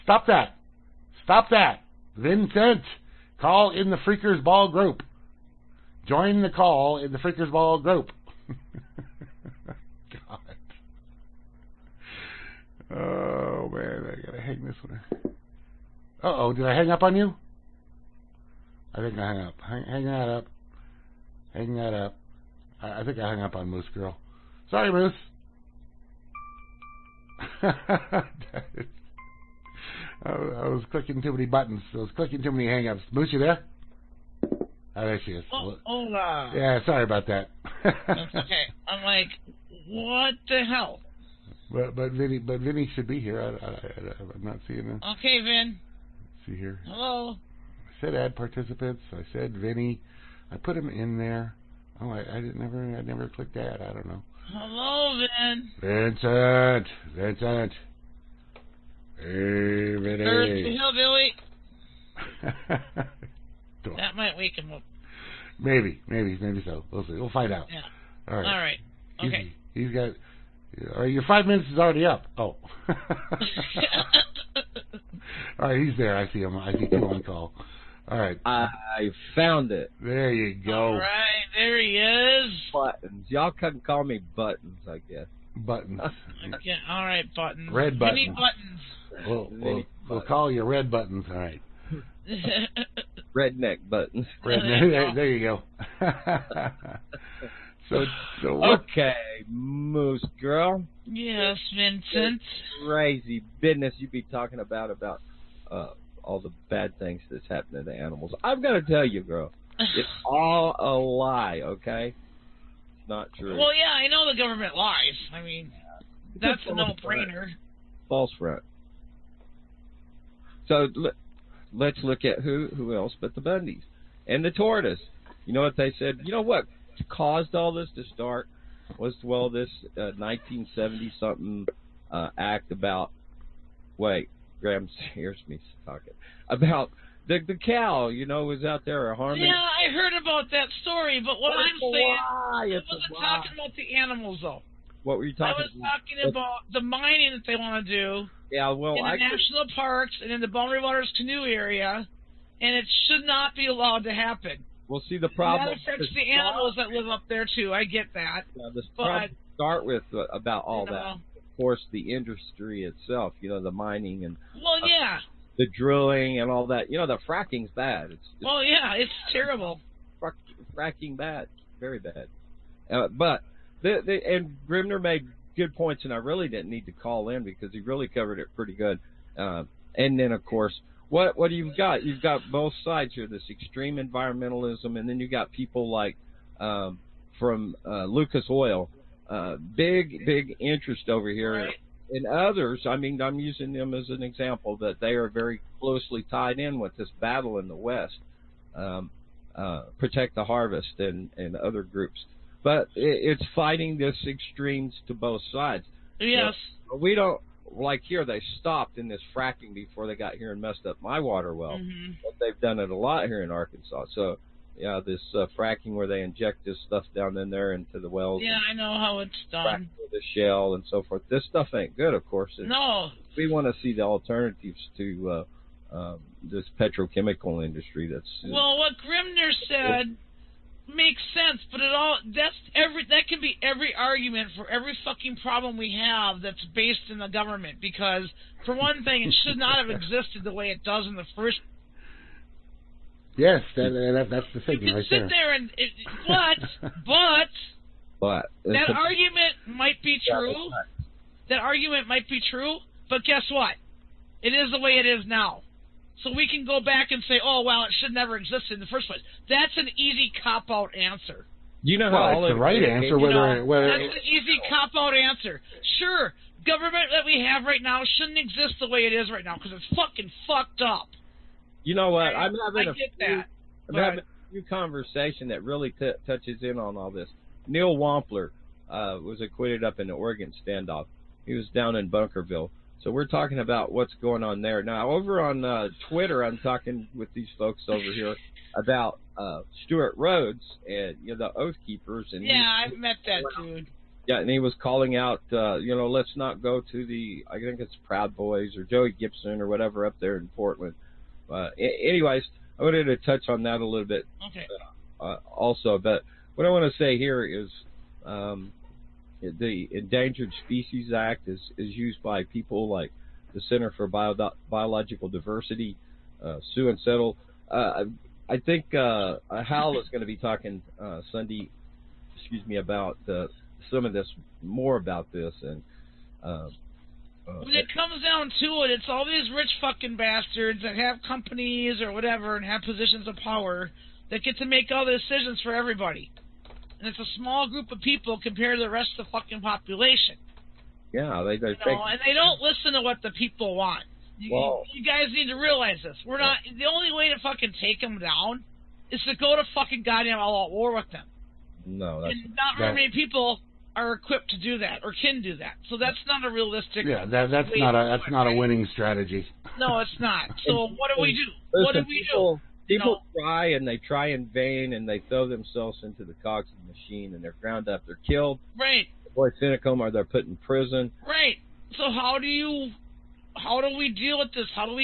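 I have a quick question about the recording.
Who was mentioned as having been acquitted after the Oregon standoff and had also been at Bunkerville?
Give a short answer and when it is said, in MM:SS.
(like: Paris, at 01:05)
Neil Wampler, at 04:37.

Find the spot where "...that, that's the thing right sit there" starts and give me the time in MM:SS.
04:03.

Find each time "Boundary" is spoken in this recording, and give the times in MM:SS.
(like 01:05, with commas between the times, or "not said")
02:30.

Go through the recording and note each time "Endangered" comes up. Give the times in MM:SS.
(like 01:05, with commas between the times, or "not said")
05:09.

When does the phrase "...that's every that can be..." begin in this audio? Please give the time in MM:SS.
03:52.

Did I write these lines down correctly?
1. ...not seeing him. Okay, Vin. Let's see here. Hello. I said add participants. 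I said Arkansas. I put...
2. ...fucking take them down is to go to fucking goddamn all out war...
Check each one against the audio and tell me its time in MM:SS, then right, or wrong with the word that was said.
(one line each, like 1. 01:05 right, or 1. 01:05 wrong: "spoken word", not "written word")
1. 00:44 wrong: "Vinny", not "Arkansas"
2. 05:47 right.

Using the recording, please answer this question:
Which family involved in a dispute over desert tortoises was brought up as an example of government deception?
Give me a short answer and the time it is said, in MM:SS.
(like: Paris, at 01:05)
Bundys, at 02:03.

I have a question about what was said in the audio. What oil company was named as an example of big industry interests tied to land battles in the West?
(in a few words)
Lucas Oil.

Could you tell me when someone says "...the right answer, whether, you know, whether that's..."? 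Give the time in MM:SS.
04:22.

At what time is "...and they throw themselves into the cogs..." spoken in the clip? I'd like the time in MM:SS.
06:04.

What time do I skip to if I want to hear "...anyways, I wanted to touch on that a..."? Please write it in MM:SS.
05:01.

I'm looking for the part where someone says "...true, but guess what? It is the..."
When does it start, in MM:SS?
04:12.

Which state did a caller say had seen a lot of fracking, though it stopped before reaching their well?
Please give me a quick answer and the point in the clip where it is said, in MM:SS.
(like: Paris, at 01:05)
Arkansas, at 03:33.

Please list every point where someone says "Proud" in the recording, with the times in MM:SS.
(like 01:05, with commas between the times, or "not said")
04:58.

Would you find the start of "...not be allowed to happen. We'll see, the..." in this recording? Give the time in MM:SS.
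02:33.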